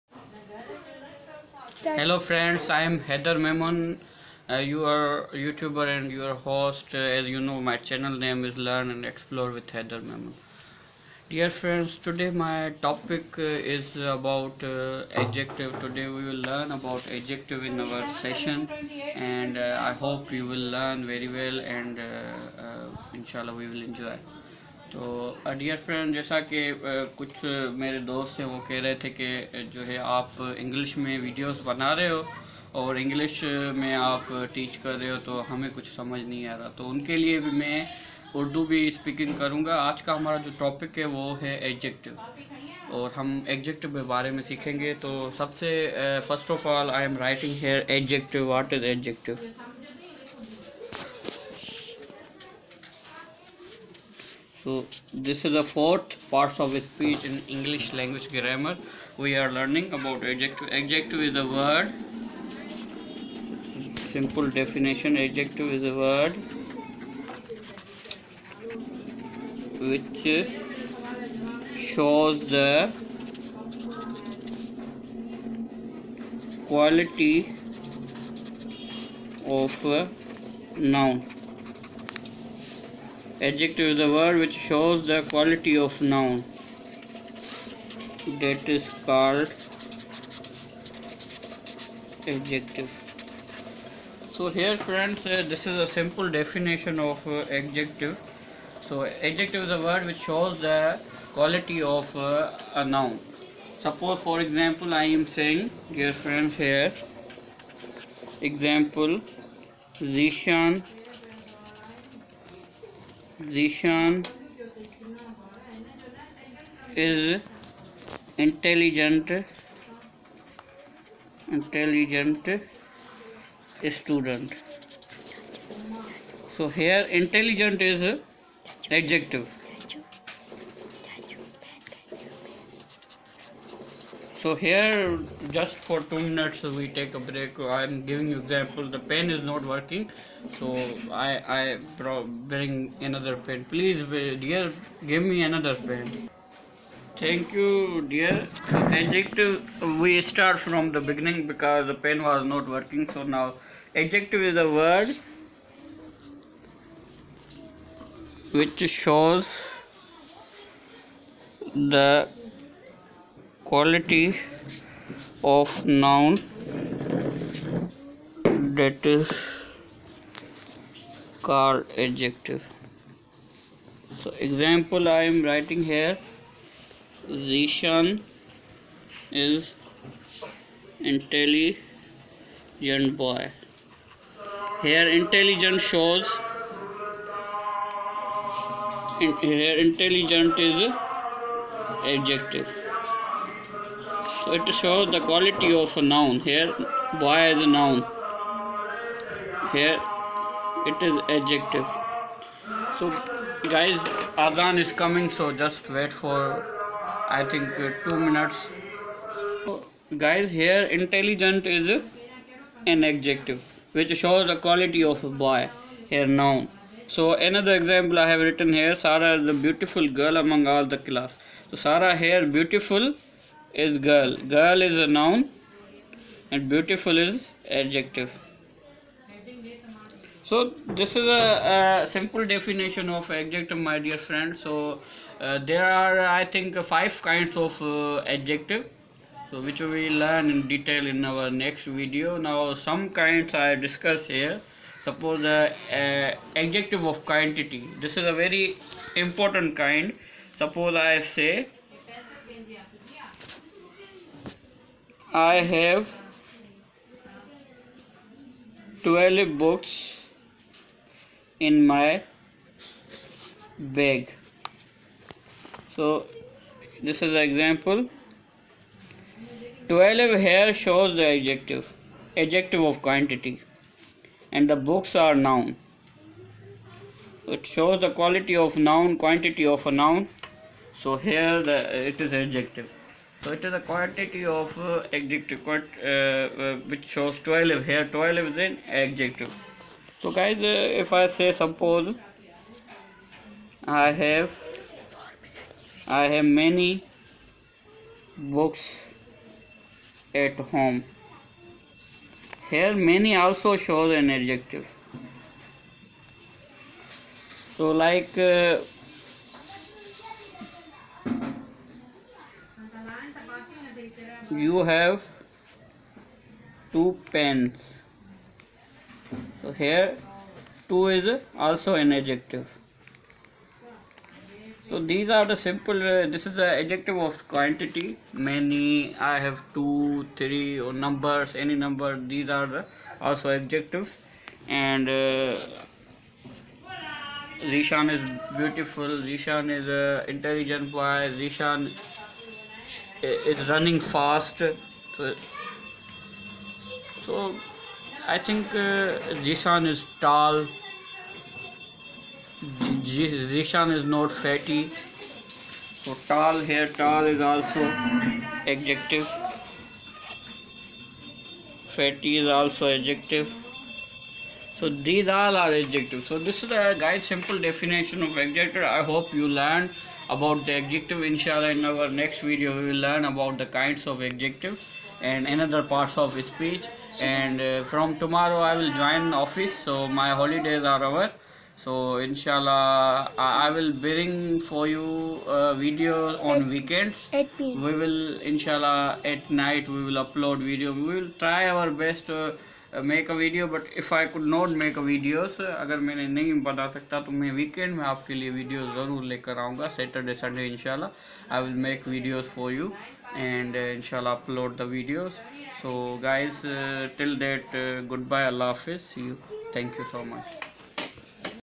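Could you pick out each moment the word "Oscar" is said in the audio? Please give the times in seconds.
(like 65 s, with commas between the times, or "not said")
not said.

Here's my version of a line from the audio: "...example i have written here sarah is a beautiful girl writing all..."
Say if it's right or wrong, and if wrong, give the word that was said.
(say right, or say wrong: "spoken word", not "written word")
wrong: "among", not "writing".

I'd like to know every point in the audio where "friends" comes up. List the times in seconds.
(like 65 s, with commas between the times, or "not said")
2 s, 11 s, 94 s, 106 s, 234 s.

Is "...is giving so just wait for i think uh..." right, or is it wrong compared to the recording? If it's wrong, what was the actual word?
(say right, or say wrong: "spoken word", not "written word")
wrong: "coming", not "giving".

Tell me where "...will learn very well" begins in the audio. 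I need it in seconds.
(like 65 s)
20 s.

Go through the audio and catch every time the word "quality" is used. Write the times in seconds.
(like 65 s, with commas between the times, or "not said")
76 s, 85 s, 101 s, 163 s, 195 s, 214 s, 278 s.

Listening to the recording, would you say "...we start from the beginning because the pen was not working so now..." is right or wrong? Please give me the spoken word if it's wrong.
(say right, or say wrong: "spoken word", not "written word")
right.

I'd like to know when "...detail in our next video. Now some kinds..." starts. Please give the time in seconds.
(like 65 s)
240 s.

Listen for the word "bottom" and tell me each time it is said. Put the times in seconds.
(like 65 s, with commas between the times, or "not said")
not said.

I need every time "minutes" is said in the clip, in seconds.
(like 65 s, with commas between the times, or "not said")
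136 s, 208 s.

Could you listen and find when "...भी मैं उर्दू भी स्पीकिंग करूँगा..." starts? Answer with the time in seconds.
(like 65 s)
37 s.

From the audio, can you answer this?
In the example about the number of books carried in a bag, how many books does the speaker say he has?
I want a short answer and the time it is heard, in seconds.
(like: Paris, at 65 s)
12, at 259 s.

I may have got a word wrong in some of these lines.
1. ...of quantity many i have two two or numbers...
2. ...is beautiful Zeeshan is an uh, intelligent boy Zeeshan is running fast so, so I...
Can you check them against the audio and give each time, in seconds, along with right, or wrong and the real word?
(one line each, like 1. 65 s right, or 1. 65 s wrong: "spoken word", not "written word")
1. 327 s wrong: "three", not "two"
2. 337 s right.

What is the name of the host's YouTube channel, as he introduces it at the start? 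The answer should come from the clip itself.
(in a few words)
Learn and Explore with Hyder Memon.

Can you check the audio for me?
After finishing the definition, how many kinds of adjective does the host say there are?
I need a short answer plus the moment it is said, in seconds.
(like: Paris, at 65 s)
5, at 236 s.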